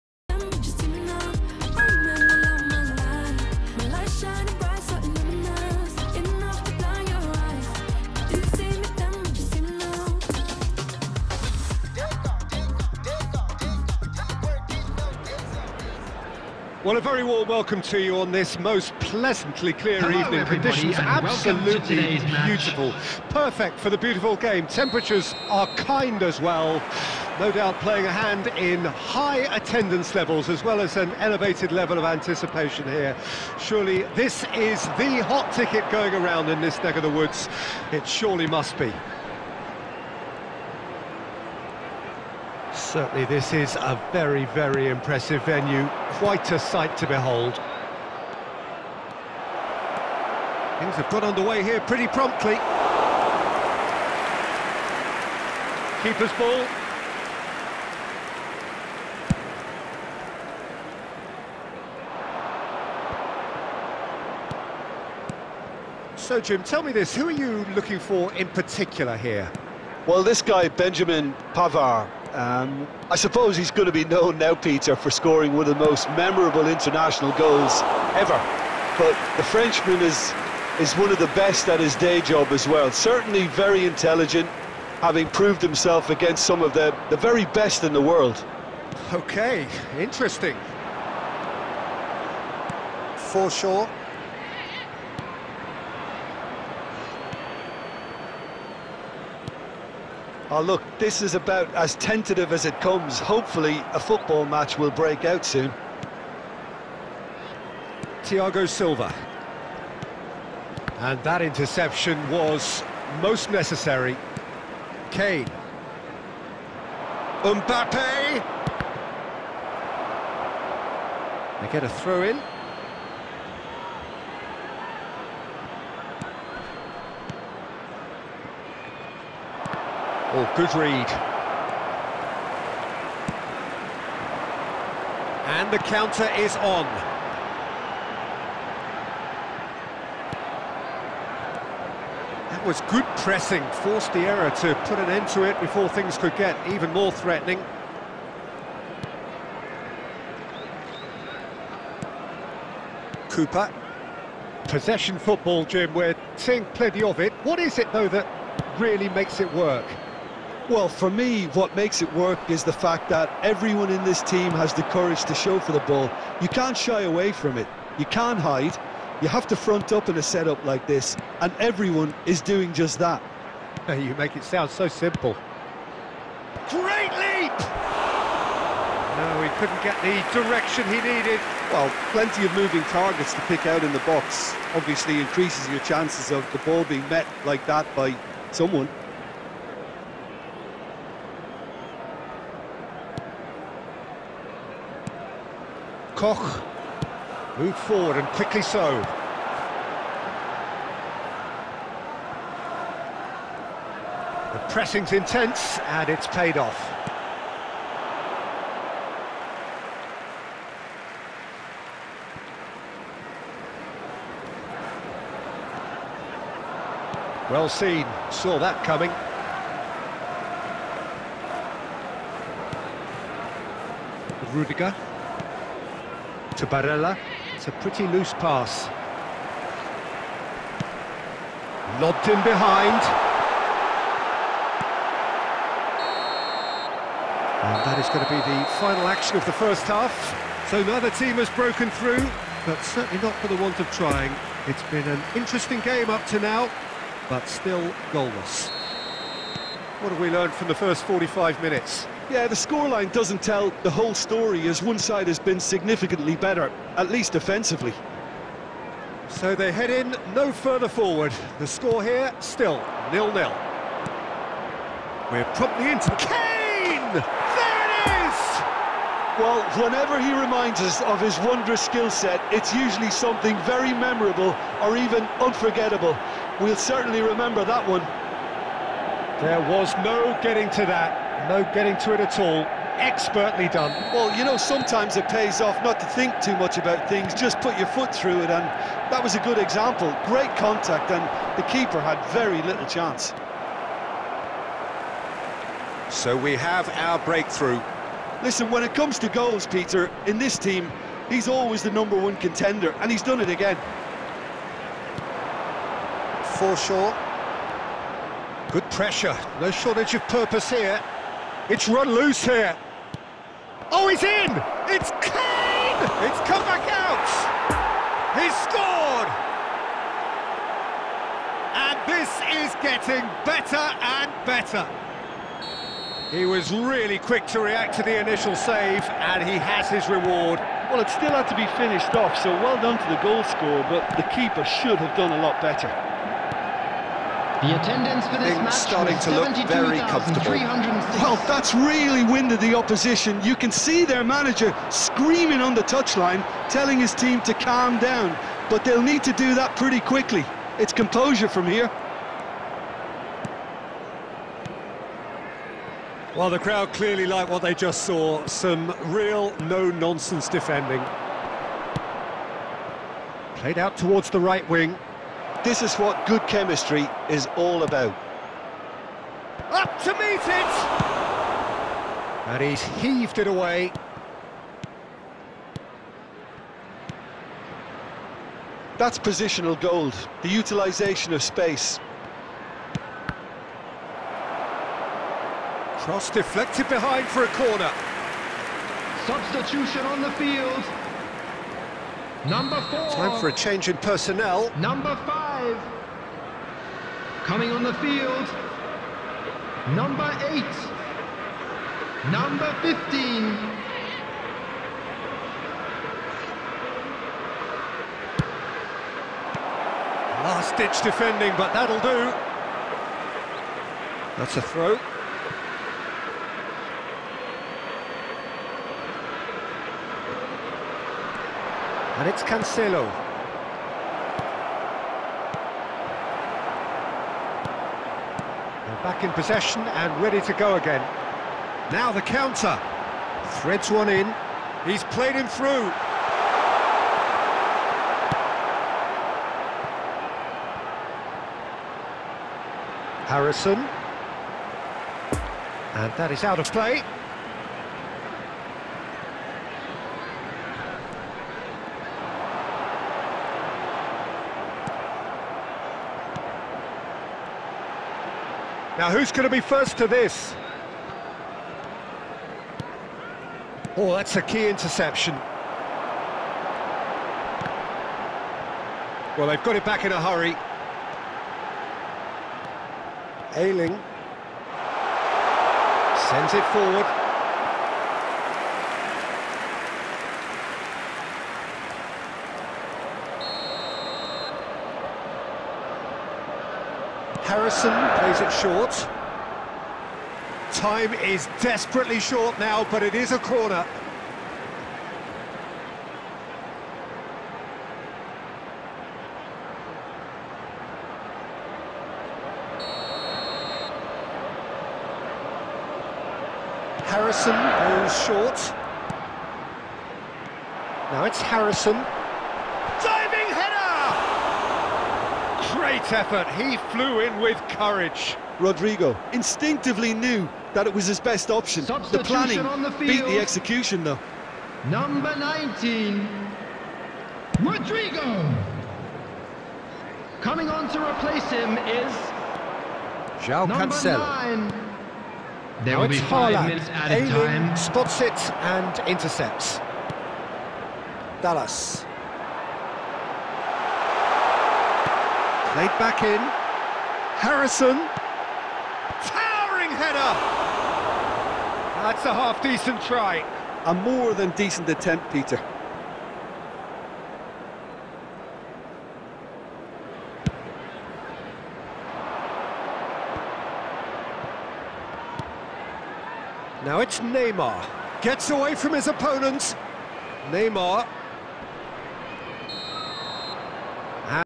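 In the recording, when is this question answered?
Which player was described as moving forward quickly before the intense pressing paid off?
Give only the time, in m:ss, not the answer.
3:16.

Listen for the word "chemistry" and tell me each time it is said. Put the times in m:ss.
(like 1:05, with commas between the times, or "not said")
6:06.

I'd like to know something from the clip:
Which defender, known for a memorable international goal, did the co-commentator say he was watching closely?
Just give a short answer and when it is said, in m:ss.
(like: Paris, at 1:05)
Benjamin Pavard, at 1:10.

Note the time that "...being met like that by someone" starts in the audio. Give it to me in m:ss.
3:06.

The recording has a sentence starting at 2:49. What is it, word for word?
You have to front up in a setup like this, and everyone is doing just that.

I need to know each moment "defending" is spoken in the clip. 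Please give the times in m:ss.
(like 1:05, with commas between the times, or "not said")
6:00, 6:51.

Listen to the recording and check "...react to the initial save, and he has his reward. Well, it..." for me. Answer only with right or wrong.
right.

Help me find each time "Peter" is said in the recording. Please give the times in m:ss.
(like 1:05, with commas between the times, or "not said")
1:14, 4:59, 9:15.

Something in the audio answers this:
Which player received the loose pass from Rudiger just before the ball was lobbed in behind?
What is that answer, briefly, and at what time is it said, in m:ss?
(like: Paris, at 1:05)
Barella, at 3:46.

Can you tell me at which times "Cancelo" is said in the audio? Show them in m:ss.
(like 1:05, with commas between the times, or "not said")
7:02, 8:53.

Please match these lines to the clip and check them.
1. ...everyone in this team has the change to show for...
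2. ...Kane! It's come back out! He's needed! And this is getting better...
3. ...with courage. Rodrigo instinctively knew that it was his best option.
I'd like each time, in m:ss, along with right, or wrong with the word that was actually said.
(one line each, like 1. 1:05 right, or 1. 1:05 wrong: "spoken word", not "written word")
1. 2:43 wrong: "courage", not "change"
2. 5:15 wrong: "scored", not "needed"
3. 8:37 right.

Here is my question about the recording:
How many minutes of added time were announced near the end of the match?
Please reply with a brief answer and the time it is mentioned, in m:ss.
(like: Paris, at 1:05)
5, at 8:56.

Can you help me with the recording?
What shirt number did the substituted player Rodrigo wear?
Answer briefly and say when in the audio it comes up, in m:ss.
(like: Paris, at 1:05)
19, at 8:44.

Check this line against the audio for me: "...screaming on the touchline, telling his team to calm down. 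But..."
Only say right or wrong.
right.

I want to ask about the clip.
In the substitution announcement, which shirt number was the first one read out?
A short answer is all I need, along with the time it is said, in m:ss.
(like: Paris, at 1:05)
4, at 6:32.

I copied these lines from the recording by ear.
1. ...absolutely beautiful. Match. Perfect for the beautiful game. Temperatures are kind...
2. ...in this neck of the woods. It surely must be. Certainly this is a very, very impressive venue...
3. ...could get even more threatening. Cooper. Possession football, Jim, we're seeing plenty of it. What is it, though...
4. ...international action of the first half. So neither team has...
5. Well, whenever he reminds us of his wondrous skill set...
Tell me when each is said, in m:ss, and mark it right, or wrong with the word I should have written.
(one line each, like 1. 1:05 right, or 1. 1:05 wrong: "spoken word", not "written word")
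1. 0:20 right
2. 0:36 right
3. 2:26 right
4. 3:58 wrong: "final", not "international"
5. 4:29 right.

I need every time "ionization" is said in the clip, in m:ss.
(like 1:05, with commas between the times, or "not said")
not said.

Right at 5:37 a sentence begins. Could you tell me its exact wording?
The attendance for this match starting to look very comfortable.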